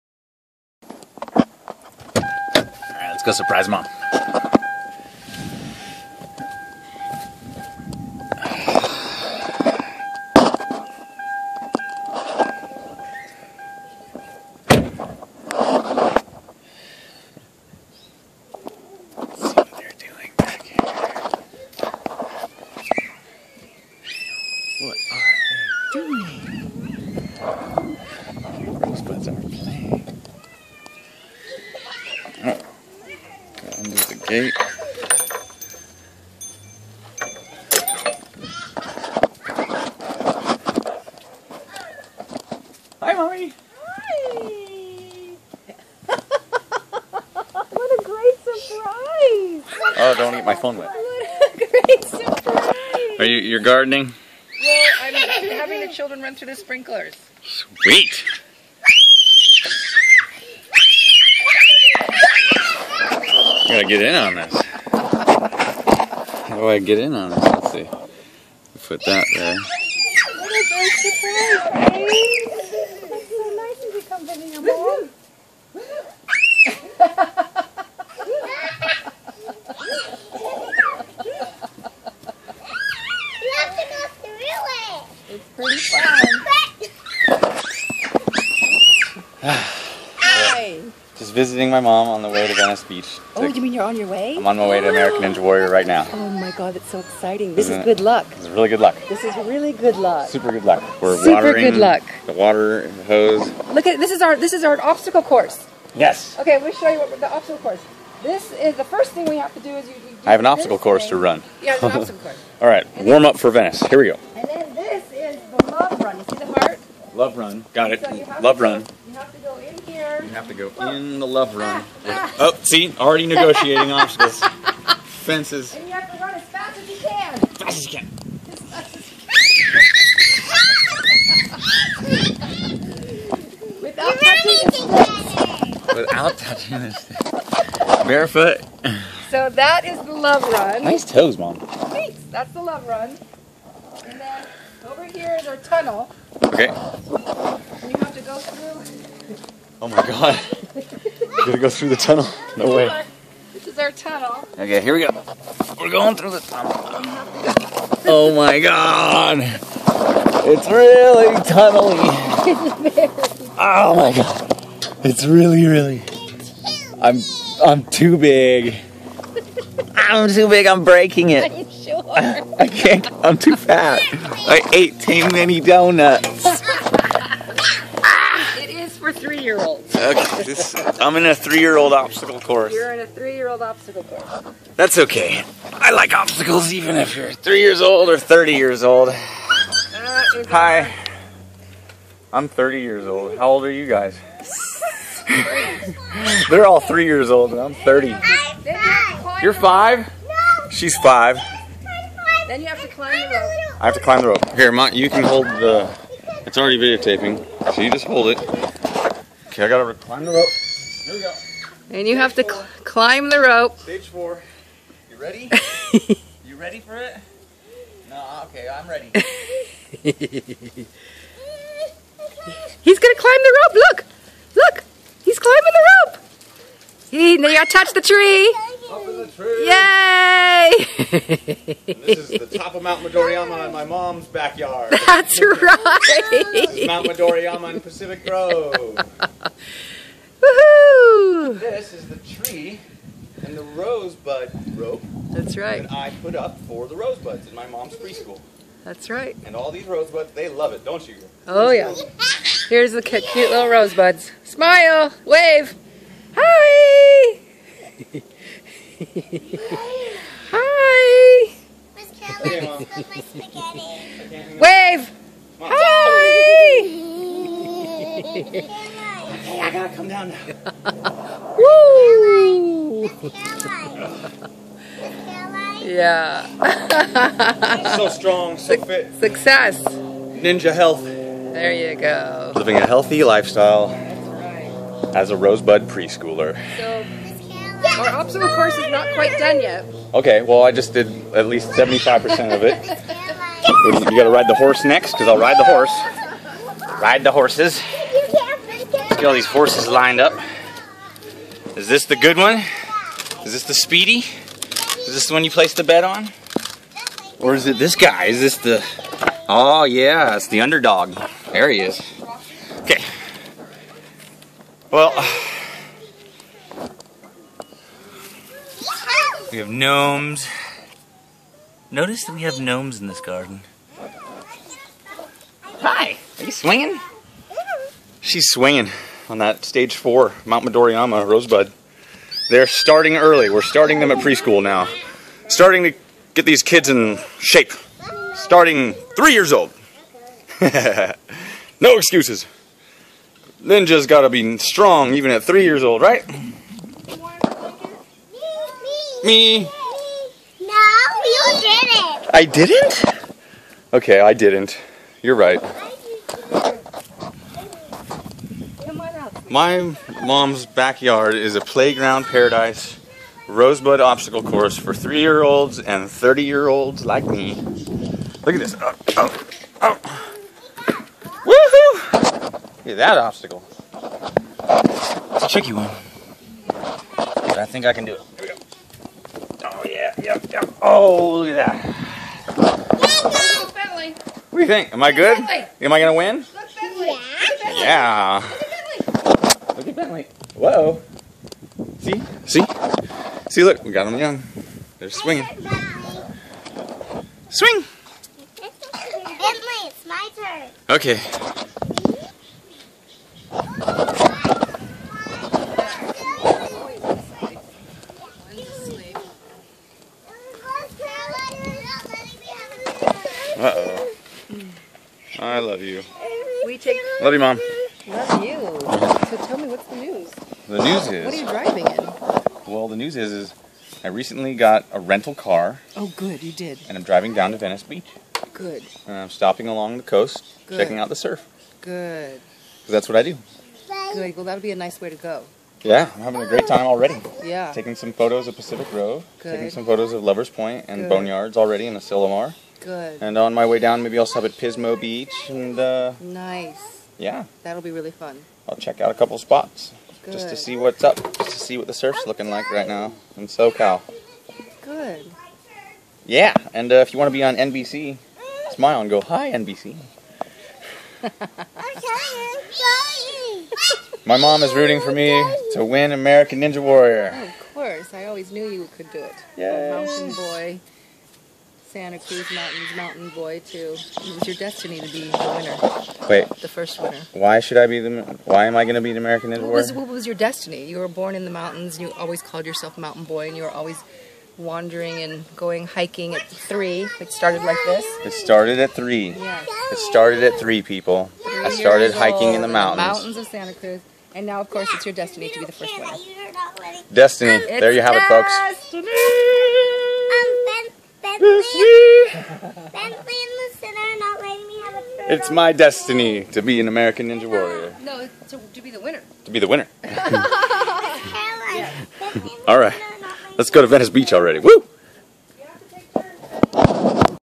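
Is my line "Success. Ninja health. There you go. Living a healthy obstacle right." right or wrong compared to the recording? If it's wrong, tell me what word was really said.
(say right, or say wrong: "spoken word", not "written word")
wrong: "lifestyle", not "obstacle".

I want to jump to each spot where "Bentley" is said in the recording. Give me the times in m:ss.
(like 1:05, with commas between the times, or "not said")
6:29, 6:38, 8:22.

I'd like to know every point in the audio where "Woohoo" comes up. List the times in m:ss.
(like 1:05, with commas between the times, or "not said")
4:00, 6:11.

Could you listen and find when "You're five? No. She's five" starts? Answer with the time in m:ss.
3:19.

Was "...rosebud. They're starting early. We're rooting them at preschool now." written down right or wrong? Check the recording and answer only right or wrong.
wrong.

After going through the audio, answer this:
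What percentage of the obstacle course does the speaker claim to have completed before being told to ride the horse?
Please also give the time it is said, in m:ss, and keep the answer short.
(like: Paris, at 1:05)
75%, at 4:51.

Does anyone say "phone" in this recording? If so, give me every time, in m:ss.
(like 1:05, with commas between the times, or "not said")
0:50.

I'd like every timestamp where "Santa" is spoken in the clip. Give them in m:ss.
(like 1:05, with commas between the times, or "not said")
7:51, 8:13.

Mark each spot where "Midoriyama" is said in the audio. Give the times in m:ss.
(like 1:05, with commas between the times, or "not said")
3:53, 3:57, 5:30.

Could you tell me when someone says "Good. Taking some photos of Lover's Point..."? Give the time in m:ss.
7:19.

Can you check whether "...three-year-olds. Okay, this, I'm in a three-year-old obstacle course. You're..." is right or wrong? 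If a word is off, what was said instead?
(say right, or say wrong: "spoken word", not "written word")
right.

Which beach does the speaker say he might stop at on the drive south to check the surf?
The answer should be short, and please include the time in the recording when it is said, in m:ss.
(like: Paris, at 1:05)
Pismo Beach, at 7:24.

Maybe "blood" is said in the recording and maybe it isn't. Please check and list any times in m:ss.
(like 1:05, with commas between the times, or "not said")
not said.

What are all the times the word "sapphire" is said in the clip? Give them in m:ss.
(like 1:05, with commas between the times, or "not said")
not said.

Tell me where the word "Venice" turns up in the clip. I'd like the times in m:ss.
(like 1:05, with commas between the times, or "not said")
1:32, 1:53, 7:07, 8:33.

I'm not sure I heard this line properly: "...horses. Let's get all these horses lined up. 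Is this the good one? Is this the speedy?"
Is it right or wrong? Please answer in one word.
right.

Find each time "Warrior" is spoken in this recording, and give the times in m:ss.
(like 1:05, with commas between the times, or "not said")
1:35, 7:46, 8:27.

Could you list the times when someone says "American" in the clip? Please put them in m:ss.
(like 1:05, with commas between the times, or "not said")
1:34, 7:46, 7:59, 8:26.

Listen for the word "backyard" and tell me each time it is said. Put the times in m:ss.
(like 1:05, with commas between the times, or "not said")
3:54, 6:00.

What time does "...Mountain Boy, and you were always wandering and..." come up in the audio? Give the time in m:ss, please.
8:02.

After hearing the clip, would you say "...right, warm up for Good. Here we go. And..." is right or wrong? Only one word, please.
wrong.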